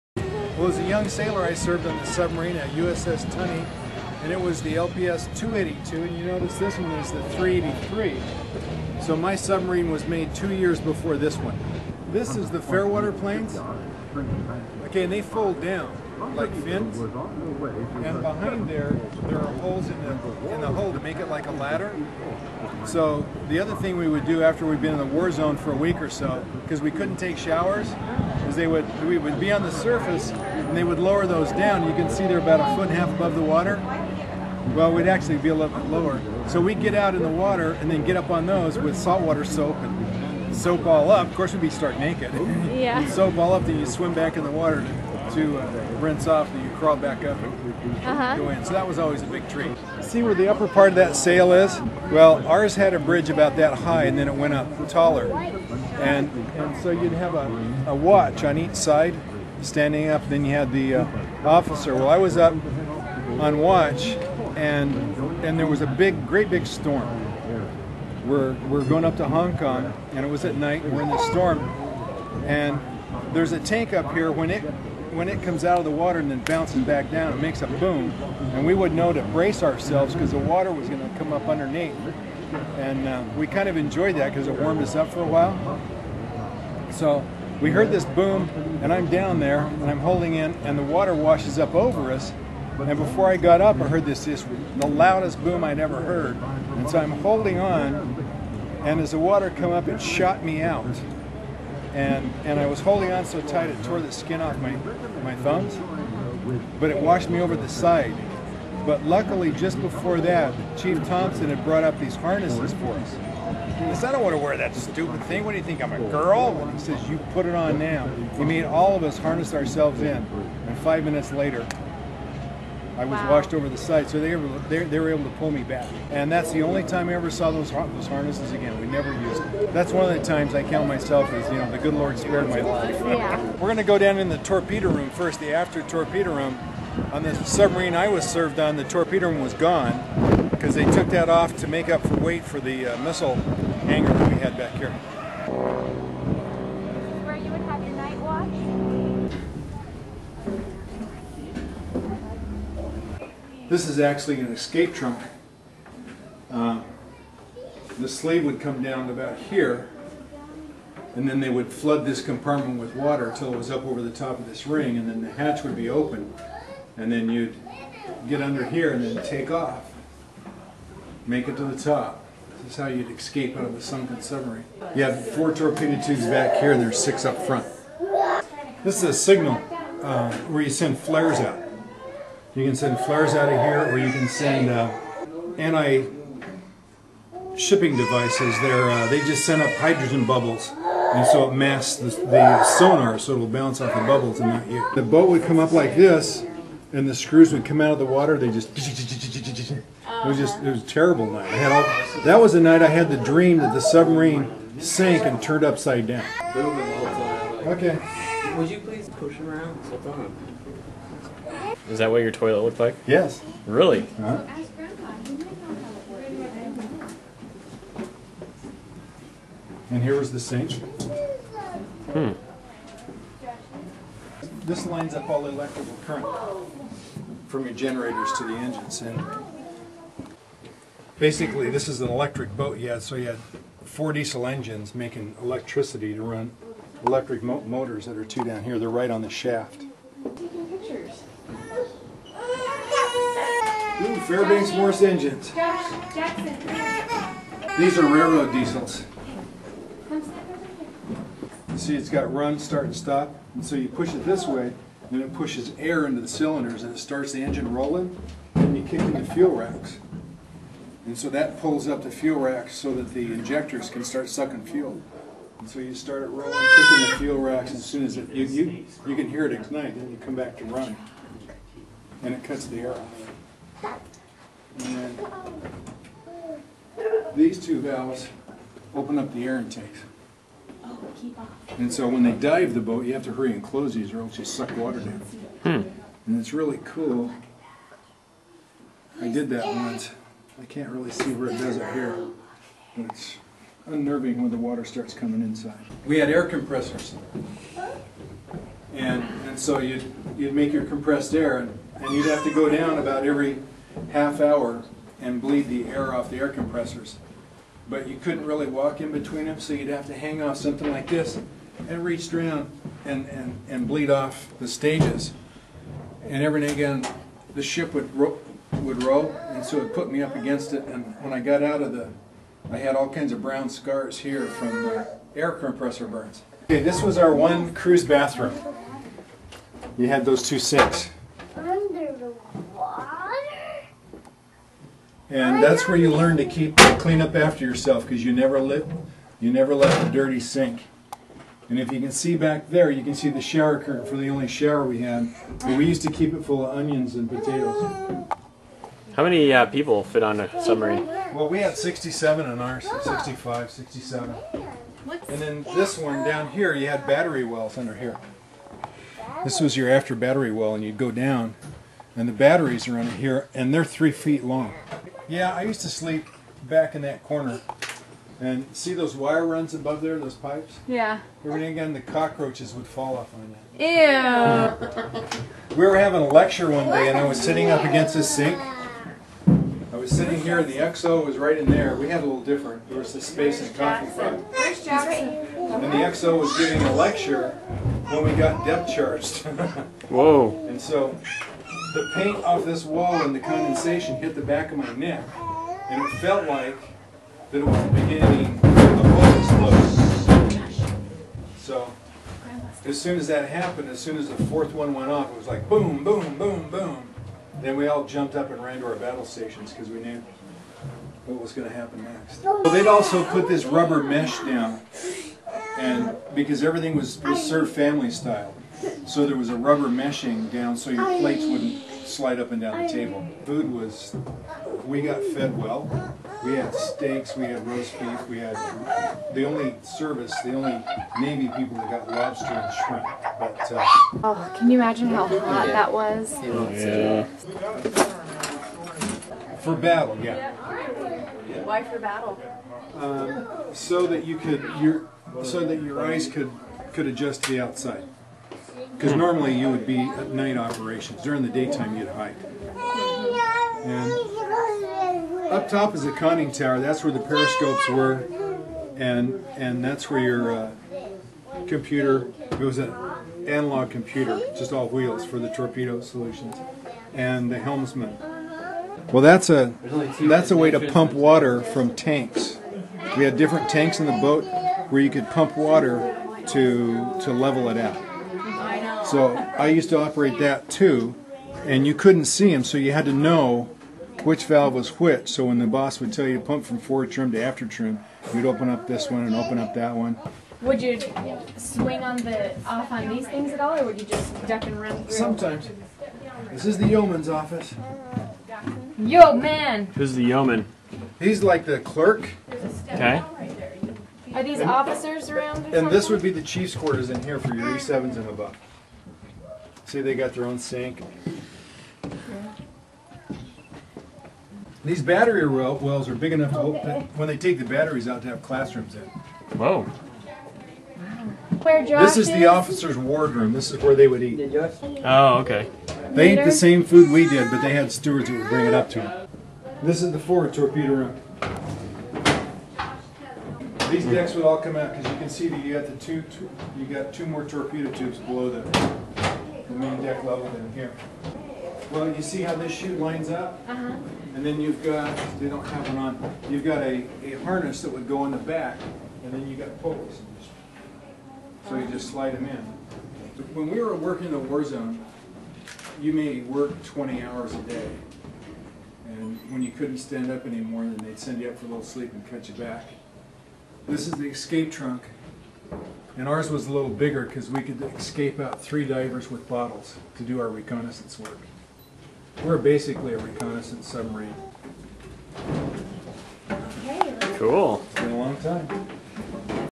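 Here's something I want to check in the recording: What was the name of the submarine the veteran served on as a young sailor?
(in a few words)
USS Tunny.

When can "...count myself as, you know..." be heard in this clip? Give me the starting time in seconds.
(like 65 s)
130 s.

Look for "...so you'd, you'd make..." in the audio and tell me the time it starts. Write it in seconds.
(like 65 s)
299 s.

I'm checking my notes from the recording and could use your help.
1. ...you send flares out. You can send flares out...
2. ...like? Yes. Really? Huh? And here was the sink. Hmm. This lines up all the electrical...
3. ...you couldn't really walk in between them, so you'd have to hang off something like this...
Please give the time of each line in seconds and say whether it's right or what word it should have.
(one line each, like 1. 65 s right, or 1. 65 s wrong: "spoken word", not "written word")
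1. 180 s right
2. 212 s right
3. 308 s right.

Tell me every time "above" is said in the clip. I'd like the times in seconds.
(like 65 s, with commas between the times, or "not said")
33 s, 369 s, 508 s.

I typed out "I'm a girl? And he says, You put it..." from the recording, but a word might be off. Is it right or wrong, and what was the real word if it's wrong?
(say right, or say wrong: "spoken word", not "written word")
right.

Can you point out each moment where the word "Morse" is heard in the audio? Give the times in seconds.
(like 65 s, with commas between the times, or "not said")
244 s.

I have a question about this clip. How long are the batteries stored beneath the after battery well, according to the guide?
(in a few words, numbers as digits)
3 feet.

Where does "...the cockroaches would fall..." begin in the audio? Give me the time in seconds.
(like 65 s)
371 s.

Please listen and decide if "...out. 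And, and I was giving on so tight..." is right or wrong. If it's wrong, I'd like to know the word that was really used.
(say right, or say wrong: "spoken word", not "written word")
wrong: "holding", not "giving".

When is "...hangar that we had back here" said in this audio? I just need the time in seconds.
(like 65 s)
143 s.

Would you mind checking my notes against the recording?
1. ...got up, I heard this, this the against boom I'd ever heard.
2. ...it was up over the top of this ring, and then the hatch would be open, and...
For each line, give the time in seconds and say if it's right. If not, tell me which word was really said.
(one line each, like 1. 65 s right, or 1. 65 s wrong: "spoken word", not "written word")
1. 93 s wrong: "loudest", not "against"
2. 163 s right.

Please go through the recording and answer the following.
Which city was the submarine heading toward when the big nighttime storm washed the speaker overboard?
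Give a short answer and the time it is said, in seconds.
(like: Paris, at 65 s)
Hong Kong, at 69 s.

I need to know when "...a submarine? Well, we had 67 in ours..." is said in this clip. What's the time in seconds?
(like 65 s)
350 s.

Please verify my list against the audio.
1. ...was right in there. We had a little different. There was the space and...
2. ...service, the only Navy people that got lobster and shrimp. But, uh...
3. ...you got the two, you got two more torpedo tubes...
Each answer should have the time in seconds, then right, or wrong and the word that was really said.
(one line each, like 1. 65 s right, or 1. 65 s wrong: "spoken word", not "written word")
1. 381 s right
2. 429 s right
3. 535 s right.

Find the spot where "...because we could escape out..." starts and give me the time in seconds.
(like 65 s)
567 s.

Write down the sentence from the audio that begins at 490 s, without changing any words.
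Would you swing on the off on these things at all, or would you just duck and run through?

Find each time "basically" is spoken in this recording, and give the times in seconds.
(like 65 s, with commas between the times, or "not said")
231 s, 572 s.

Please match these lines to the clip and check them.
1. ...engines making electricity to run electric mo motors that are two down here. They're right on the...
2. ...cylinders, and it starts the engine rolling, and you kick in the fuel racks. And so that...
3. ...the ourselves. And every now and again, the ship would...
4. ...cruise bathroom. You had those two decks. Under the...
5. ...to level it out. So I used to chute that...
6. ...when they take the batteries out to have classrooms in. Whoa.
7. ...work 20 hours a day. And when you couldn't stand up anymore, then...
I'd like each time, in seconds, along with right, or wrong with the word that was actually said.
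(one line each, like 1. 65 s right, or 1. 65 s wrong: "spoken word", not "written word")
1. 234 s right
2. 256 s right
3. 314 s wrong: "stages", not "ourselves"
4. 327 s wrong: "sinks", not "decks"
5. 477 s wrong: "operate", not "chute"
6. 517 s right
7. 556 s right.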